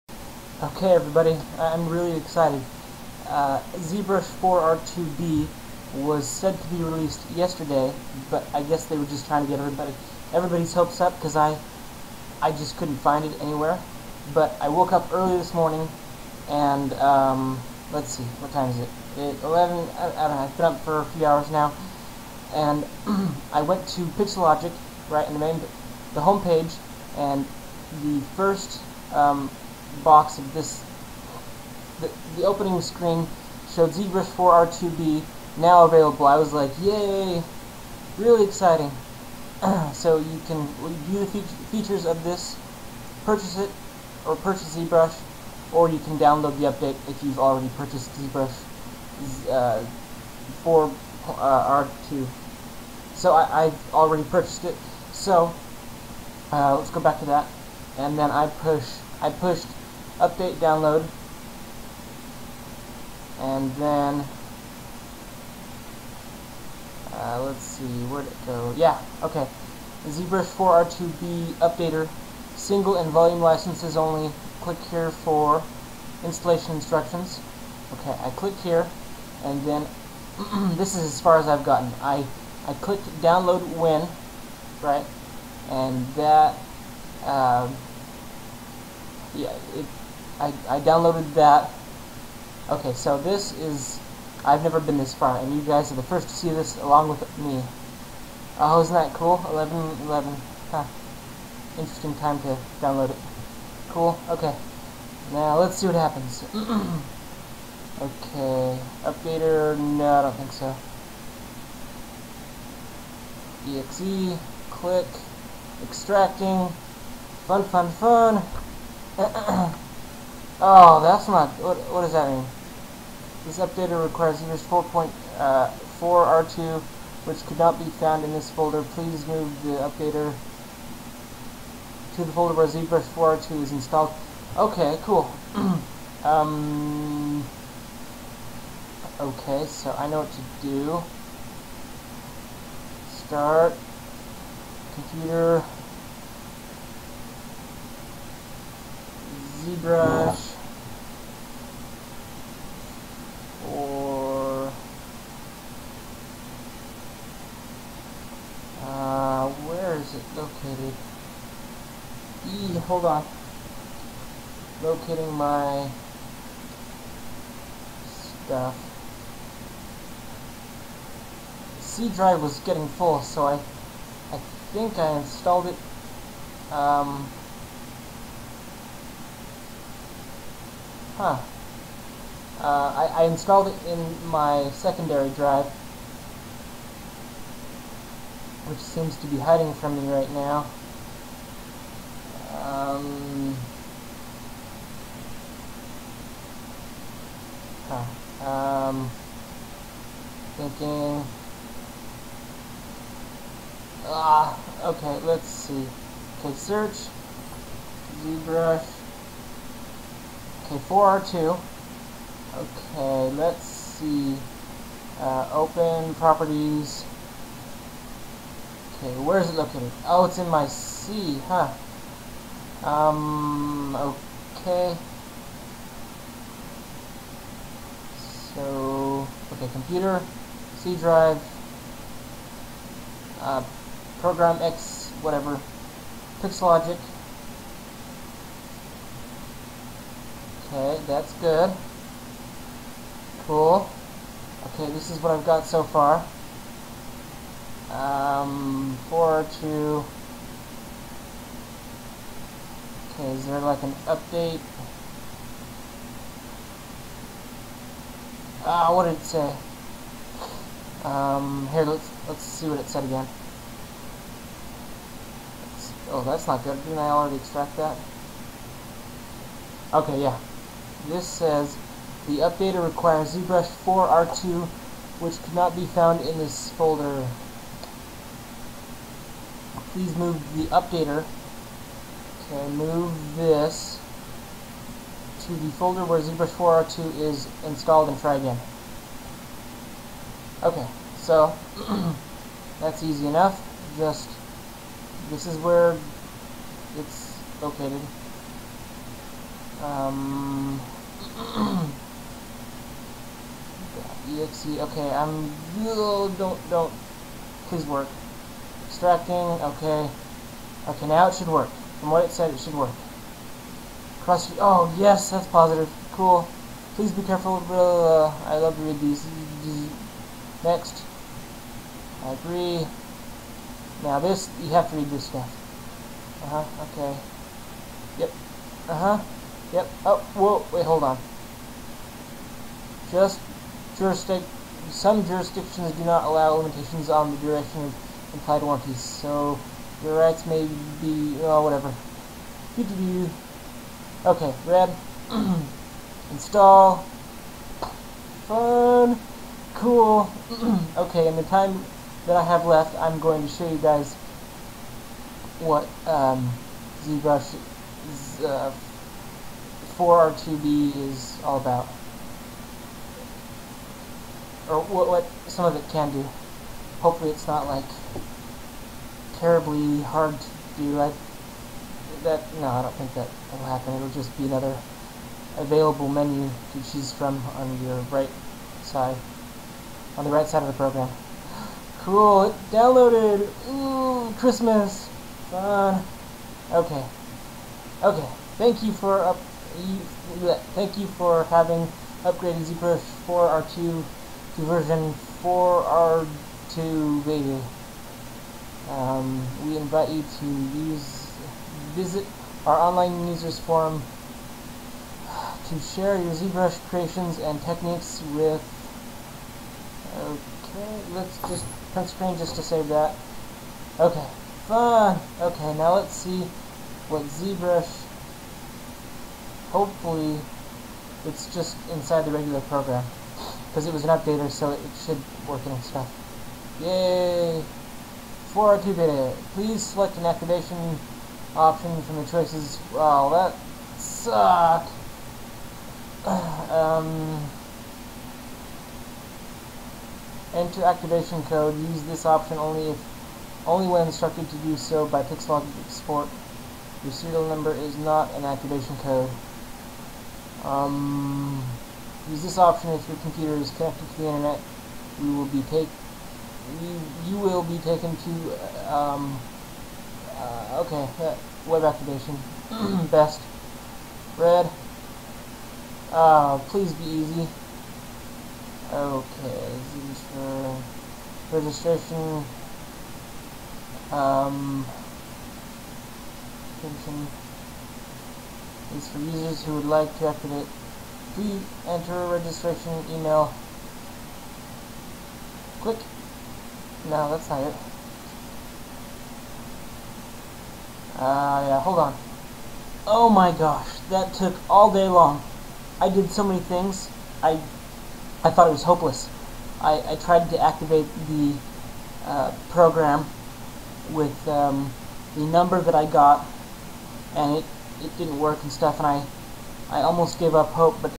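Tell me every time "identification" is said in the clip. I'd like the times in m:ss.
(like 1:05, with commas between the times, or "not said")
not said.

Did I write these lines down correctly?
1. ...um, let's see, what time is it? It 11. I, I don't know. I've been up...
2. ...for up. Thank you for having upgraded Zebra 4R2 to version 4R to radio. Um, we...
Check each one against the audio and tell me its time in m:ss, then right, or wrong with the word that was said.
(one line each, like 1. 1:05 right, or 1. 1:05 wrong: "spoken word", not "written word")
1. 0:16 right
2. 6:28 wrong: "ZBrush", not "Zebra".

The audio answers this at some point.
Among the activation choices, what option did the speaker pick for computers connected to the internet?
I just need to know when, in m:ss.
7:41.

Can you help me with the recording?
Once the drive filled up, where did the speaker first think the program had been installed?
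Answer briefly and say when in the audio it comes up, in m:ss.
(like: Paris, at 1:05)
secondary drive, at 3:04.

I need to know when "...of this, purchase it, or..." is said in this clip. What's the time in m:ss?
0:42.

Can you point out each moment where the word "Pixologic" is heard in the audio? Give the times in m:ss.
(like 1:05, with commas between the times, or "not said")
3:56, 7:25.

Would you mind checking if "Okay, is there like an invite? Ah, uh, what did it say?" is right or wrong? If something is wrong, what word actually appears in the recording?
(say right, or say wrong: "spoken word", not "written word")
wrong: "update", not "invite".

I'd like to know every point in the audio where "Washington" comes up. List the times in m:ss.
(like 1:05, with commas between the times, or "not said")
not said.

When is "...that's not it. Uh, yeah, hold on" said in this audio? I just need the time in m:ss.
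8:07.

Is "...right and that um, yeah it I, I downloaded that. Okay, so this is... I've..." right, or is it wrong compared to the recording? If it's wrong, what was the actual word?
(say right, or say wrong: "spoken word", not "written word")
right.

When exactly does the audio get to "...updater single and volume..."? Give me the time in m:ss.
1:11.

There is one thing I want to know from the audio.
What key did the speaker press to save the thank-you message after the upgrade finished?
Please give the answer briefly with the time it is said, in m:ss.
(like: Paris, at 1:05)
print screen, at 6:51.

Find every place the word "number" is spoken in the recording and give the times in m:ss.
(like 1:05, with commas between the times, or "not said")
7:27, 8:25.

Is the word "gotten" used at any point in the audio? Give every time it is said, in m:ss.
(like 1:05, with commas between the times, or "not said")
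1:21.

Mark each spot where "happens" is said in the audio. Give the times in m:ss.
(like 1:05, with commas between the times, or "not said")
1:45, 6:13.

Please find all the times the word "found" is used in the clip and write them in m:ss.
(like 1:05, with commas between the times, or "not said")
2:07, 4:35.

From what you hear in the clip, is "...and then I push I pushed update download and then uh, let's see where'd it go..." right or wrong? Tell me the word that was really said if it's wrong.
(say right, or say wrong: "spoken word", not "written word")
right.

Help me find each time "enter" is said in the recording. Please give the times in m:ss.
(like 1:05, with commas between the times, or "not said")
7:20, 8:01.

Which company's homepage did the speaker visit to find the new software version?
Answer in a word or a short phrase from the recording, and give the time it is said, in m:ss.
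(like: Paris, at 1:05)
Pixelogic, at 0:24.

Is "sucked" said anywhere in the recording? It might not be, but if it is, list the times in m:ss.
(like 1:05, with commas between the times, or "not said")
7:14.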